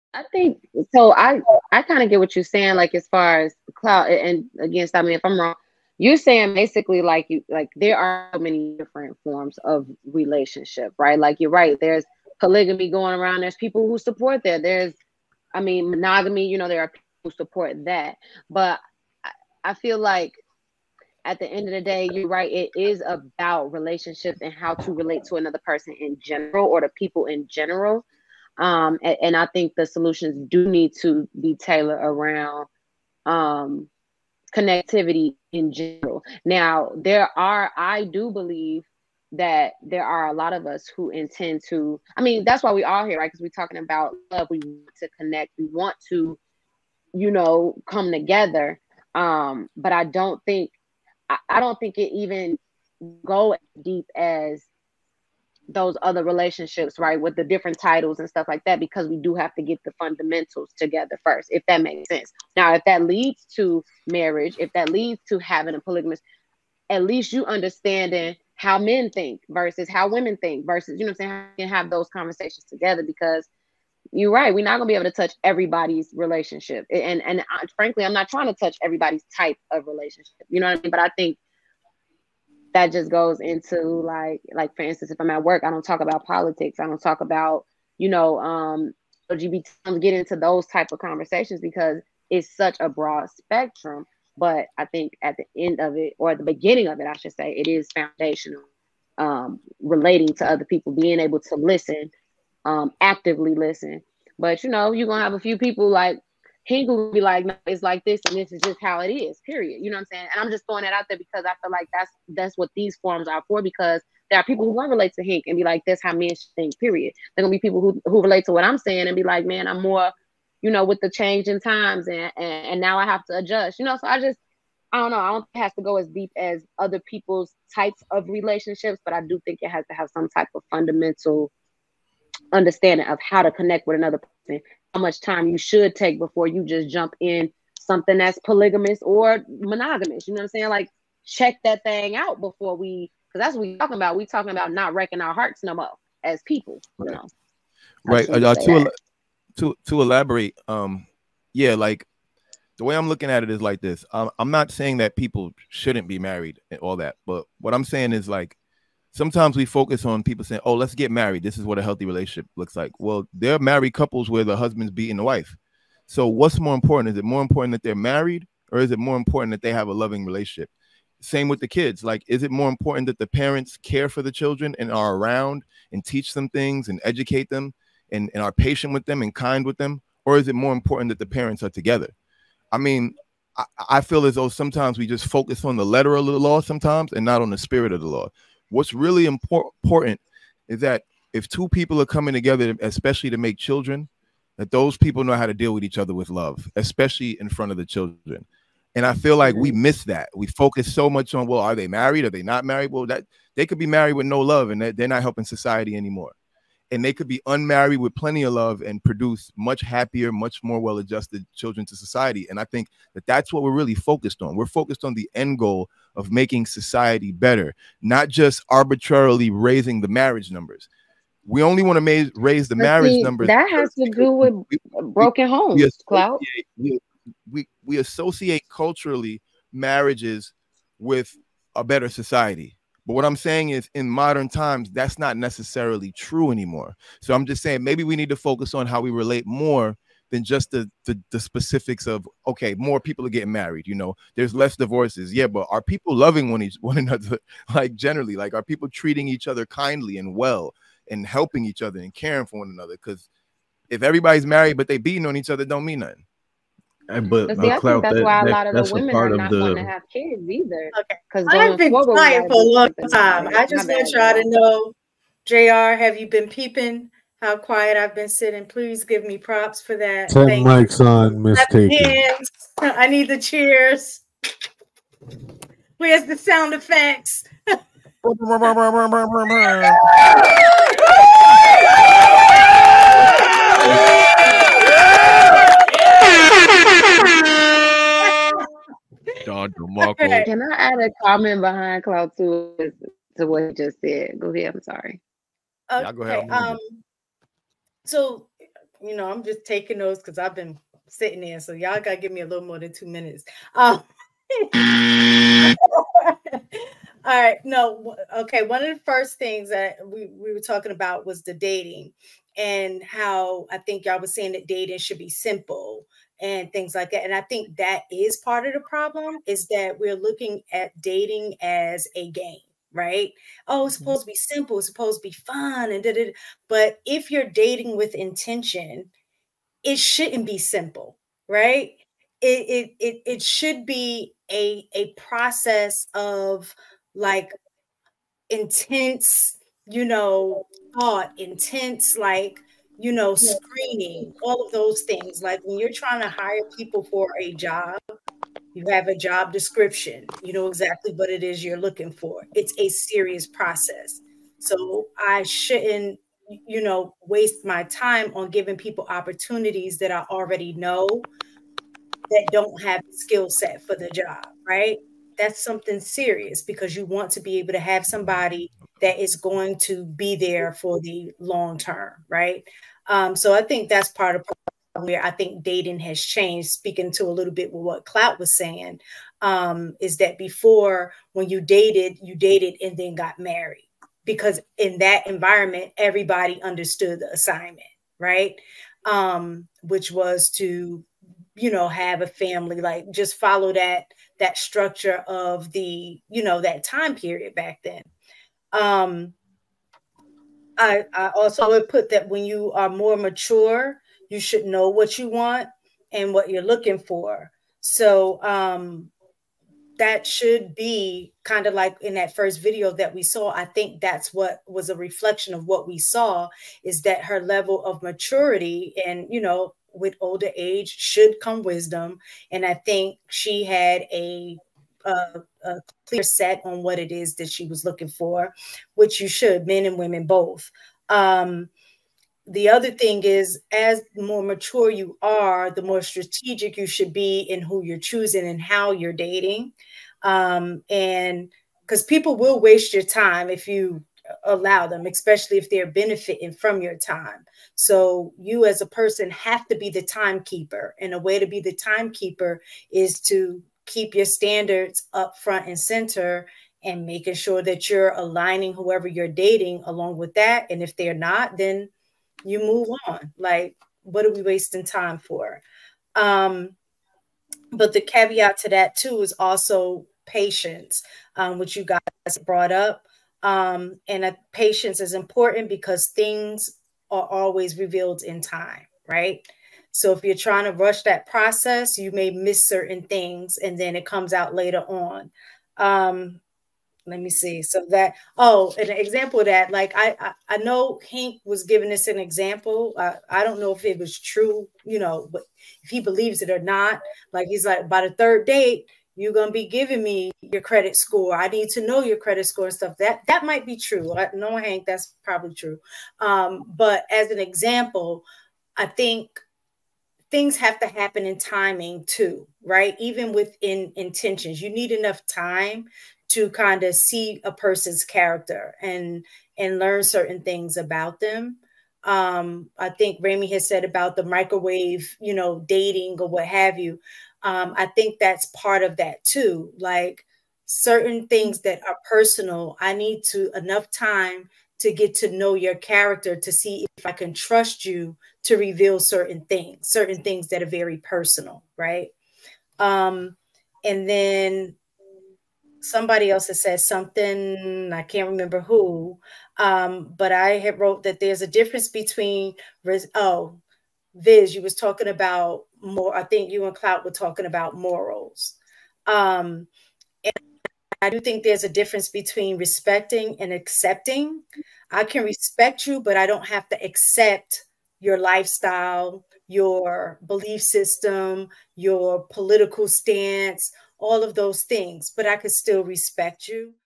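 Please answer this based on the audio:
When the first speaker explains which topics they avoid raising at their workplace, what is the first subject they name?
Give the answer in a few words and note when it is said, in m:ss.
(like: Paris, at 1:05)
politics, at 1:26.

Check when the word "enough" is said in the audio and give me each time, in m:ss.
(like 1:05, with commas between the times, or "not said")
8:34, 8:53.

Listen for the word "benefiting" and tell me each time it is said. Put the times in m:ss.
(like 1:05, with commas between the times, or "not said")
7:25.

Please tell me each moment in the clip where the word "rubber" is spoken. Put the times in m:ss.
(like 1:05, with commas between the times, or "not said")
not said.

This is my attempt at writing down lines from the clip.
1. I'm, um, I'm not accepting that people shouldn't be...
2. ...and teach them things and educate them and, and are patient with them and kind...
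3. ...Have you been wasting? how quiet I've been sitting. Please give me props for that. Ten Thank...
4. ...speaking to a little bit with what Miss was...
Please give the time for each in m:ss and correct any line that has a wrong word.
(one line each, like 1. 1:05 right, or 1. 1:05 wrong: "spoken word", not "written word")
1. 2:34 wrong: "saying", not "accepting"
2. 2:55 right
3. 4:26 wrong: "peeping", not "wasting"
4. 6:16 wrong: "Clout", not "Miss".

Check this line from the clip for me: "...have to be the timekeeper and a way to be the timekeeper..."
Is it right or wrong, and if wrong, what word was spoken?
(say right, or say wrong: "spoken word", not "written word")
right.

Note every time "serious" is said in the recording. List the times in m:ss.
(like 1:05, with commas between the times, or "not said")
5:52, 6:05.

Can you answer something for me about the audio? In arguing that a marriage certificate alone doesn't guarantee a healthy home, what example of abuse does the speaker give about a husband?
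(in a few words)
beating the wife.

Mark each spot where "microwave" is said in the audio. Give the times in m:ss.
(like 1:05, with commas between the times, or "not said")
8:44.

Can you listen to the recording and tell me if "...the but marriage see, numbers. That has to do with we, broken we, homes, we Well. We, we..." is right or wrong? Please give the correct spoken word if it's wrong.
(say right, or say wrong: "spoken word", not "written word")
wrong: "Clout", not "Well".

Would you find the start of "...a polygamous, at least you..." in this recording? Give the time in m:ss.
1:05.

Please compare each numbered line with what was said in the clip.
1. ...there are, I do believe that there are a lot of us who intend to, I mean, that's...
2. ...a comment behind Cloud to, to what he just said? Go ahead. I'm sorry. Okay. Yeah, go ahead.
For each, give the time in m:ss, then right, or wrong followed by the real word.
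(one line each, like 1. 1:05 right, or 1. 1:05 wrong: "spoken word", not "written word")
1. 0:36 right
2. 4:50 right.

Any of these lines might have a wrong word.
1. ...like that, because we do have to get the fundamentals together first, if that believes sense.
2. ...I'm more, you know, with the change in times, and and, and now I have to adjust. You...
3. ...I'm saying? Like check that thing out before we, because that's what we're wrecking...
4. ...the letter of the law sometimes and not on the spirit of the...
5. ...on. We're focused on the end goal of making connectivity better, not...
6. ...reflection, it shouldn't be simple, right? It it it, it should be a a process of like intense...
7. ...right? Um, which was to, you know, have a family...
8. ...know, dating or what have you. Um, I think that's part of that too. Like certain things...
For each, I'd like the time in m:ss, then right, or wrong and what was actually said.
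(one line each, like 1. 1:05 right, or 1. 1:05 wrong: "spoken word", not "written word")
1. 0:58 wrong: "makes", not "believes"
2. 1:59 right
3. 2:20 wrong: "talking", not "wrecking"
4. 3:05 right
5. 3:34 wrong: "society", not "connectivity"
6. 5:28 wrong: "intention", not "reflection"
7. 6:28 right
8. 8:45 right.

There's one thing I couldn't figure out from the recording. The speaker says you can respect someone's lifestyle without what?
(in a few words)
accepting.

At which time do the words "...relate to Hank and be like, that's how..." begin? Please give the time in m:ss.
1:54.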